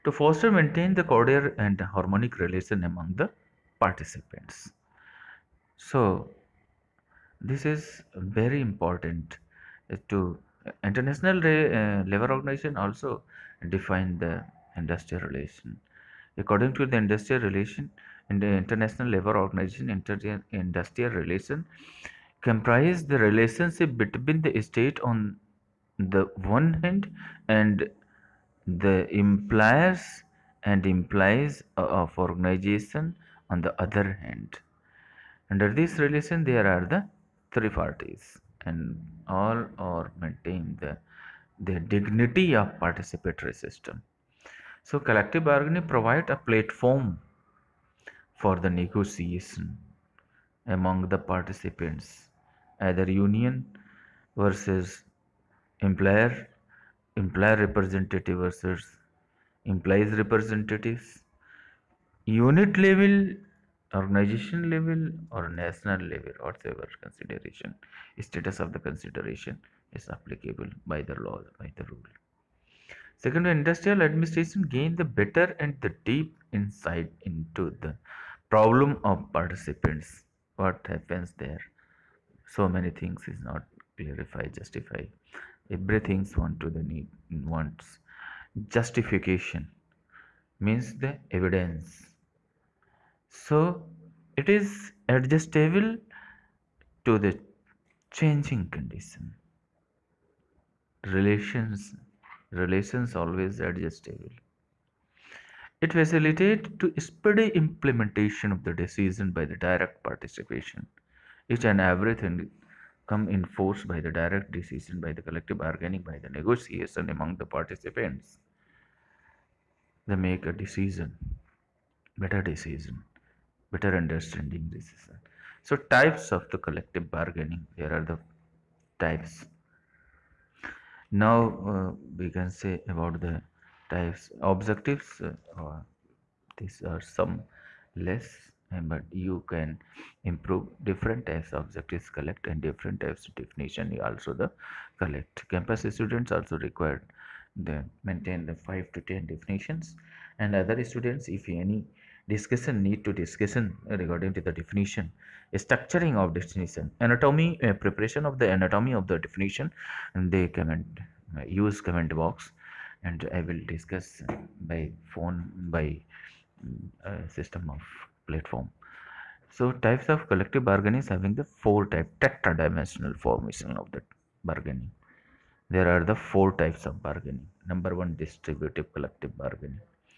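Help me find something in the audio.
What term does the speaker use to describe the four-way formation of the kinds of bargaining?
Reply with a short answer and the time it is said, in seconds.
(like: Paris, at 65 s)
tetradimensional, at 172 s.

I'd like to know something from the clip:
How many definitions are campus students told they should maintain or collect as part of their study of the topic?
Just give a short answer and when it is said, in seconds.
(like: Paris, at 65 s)
5 to 10, at 148 s.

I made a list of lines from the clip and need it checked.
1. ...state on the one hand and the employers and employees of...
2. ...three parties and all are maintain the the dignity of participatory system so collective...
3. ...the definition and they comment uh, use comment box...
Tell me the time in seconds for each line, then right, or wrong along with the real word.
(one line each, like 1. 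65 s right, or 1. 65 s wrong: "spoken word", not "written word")
1. 24 s right
2. 37 s right
3. 159 s right.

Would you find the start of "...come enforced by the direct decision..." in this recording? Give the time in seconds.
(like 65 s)
113 s.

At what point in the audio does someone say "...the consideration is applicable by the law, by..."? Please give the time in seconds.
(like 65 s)
68 s.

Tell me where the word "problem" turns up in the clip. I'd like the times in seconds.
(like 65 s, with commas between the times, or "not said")
78 s.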